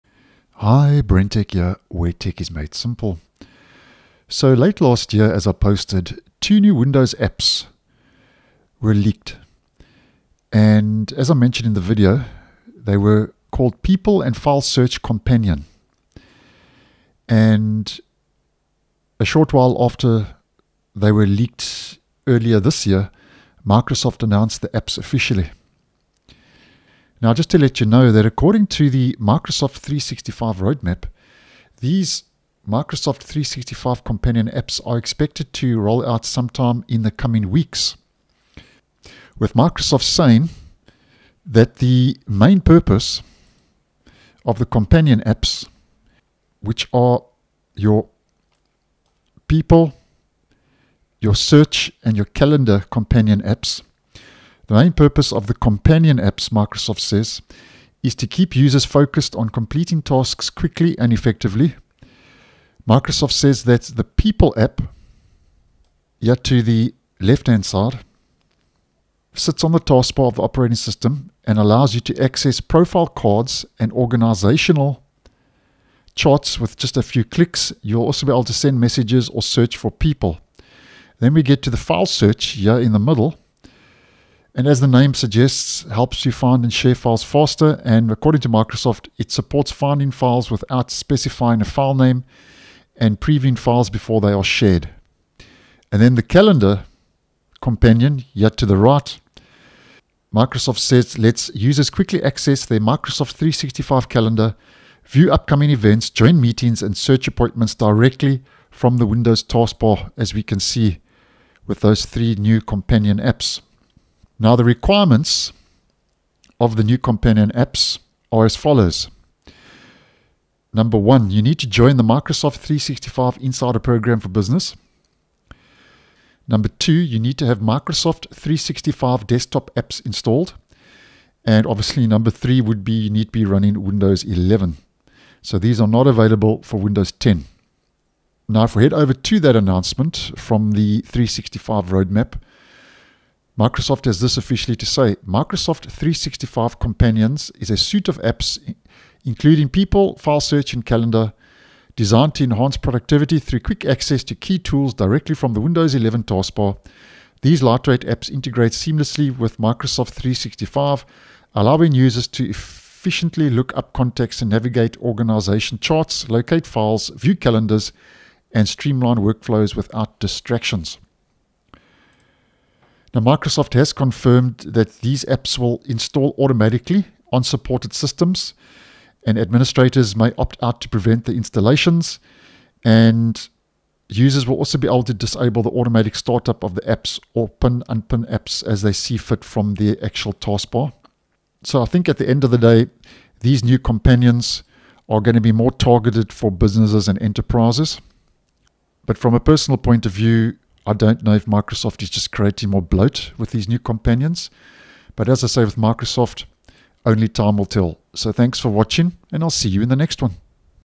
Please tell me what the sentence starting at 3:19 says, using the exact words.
But from a personal point of view, I don't know if Microsoft is just creating more bloat with these new companions.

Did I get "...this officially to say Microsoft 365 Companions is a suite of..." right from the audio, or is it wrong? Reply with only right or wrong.
right.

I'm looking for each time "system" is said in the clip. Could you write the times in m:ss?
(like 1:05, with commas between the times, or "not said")
1:10, 2:57.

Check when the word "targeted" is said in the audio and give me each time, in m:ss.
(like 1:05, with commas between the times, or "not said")
3:15.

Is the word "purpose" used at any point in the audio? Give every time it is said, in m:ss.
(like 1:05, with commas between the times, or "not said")
0:42, 0:54.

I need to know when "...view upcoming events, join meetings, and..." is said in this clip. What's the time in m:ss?
1:45.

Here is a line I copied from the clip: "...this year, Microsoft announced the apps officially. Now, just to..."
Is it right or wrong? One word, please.
right.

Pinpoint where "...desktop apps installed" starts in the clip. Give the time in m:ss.
2:09.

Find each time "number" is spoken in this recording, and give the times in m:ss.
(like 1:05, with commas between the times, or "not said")
2:00, 2:06, 2:12.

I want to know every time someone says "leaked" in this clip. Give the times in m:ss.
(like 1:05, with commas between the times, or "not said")
0:08, 0:21.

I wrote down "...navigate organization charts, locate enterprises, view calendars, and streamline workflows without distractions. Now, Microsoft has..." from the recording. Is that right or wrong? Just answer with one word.
wrong.